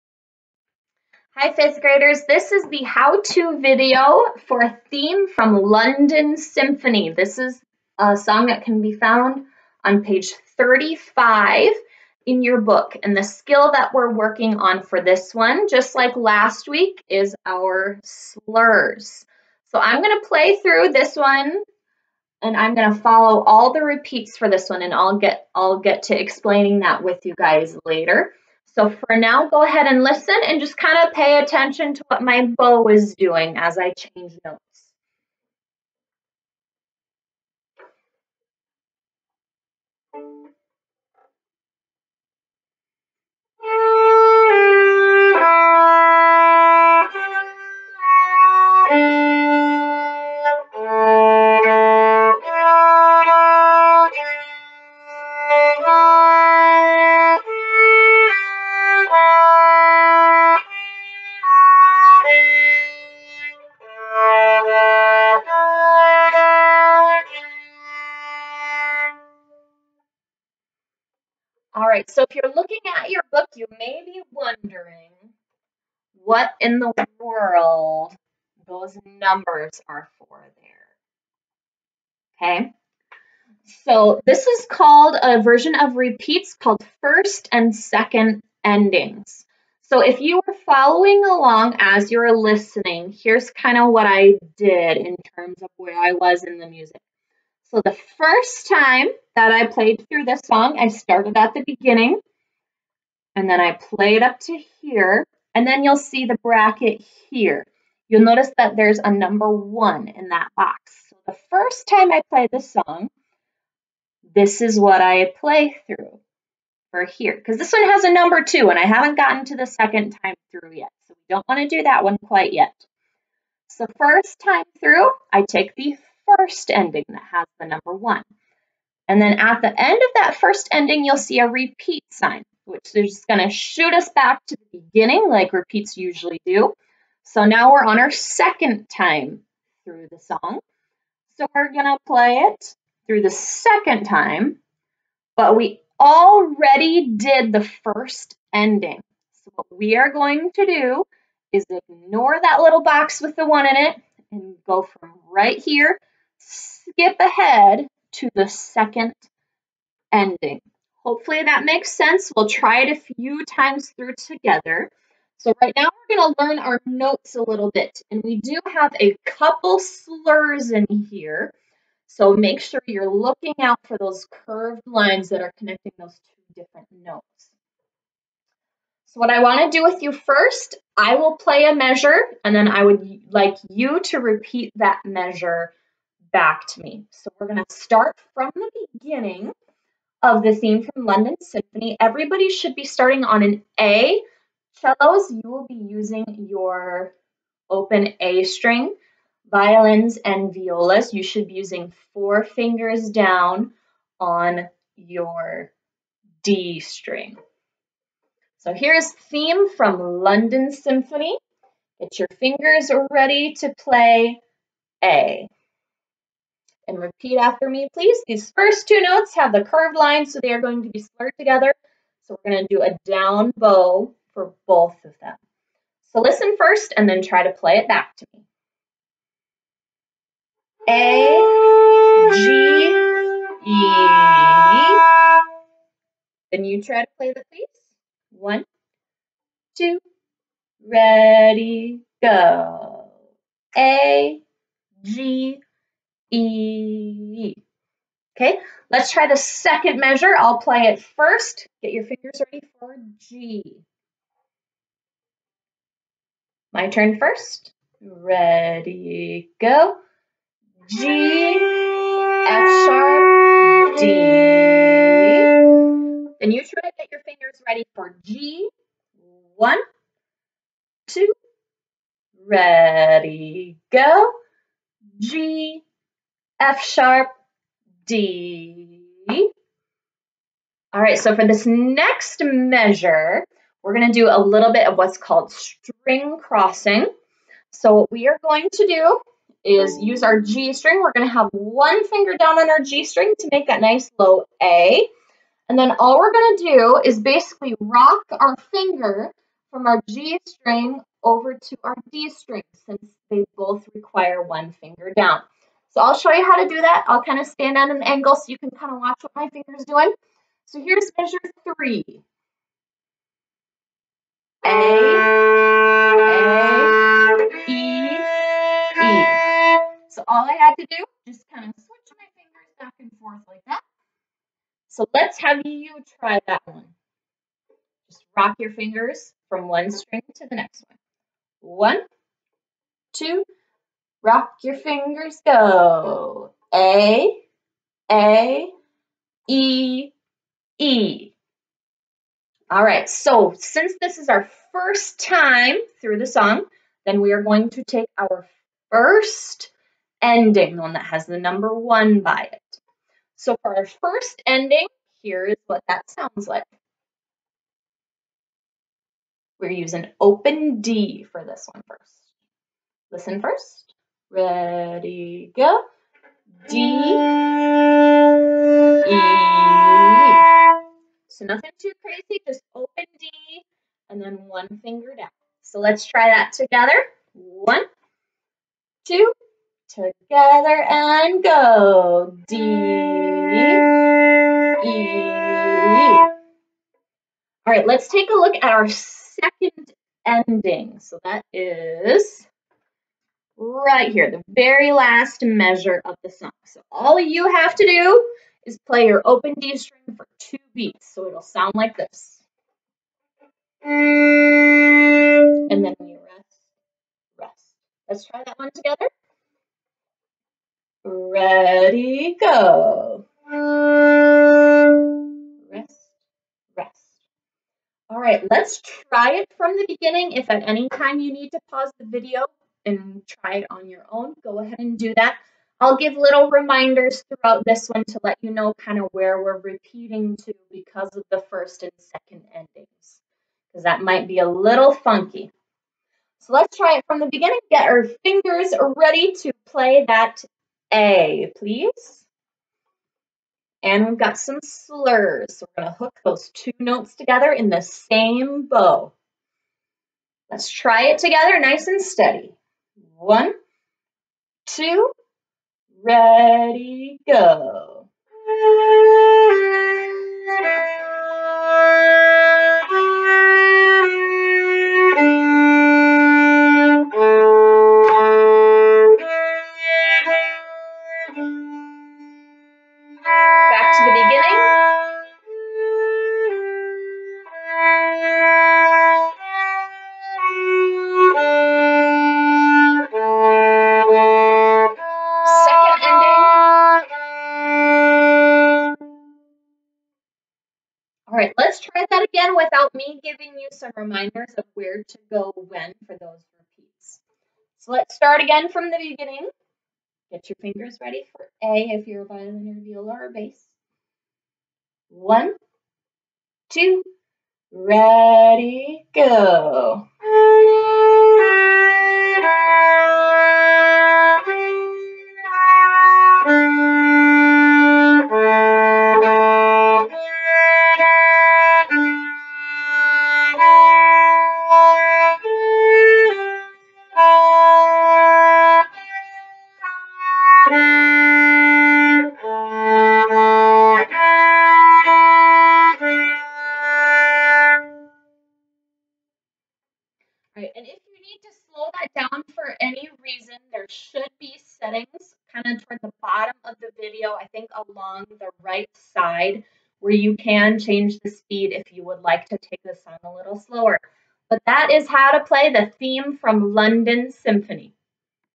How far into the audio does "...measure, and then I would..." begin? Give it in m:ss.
3:01.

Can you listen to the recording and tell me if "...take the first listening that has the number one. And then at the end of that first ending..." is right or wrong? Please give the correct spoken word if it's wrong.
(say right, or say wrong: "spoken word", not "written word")
wrong: "ending", not "listening".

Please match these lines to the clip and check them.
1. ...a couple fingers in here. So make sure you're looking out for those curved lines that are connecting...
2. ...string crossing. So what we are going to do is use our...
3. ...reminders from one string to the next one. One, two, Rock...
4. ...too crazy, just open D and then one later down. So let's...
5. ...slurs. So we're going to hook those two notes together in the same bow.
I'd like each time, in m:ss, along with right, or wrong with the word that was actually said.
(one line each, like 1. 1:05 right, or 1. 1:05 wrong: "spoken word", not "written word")
1. 2:49 wrong: "slurs", not "fingers"
2. 4:45 right
3. 5:28 wrong: "fingers", not "reminders"
4. 6:11 wrong: "finger", not "later"
5. 7:24 right.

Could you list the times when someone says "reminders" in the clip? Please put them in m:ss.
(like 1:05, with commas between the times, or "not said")
7:06, 8:13.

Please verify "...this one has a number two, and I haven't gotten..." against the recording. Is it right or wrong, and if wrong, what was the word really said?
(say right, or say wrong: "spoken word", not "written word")
right.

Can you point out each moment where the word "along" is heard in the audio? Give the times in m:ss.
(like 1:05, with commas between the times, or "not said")
1:31, 9:07.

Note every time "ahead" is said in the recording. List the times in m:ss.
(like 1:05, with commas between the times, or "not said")
0:29, 2:37, 7:04.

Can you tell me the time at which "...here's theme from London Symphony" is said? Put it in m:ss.
3:28.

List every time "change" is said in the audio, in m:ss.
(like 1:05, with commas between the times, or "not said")
0:33, 9:10.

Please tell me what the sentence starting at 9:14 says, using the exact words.
But that is how to play the theme from London Symphony.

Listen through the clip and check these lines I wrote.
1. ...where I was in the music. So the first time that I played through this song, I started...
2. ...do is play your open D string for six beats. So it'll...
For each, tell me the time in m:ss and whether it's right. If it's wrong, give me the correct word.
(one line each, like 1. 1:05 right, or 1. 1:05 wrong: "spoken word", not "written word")
1. 1:35 right
2. 6:37 wrong: "two", not "six".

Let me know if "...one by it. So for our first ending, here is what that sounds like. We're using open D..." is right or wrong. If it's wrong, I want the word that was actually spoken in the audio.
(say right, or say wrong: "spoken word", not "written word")
right.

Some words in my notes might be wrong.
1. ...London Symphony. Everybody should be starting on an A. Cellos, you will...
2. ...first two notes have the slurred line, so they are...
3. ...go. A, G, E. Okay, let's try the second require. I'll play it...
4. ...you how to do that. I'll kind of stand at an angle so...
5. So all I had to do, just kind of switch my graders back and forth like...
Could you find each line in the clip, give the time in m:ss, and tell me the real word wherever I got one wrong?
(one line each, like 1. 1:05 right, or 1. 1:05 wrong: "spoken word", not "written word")
1. 3:11 right
2. 3:38 wrong: "curved", not "slurred"
3. 4:02 wrong: "measure", not "require"
4. 5:06 right
5. 5:20 wrong: "fingers", not "graders".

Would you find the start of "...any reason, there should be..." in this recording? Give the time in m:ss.
9:02.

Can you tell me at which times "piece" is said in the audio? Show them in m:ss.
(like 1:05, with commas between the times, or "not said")
3:57.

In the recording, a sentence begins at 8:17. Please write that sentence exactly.
So let's start again from the beginning.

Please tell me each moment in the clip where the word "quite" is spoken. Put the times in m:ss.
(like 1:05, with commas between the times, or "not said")
2:02.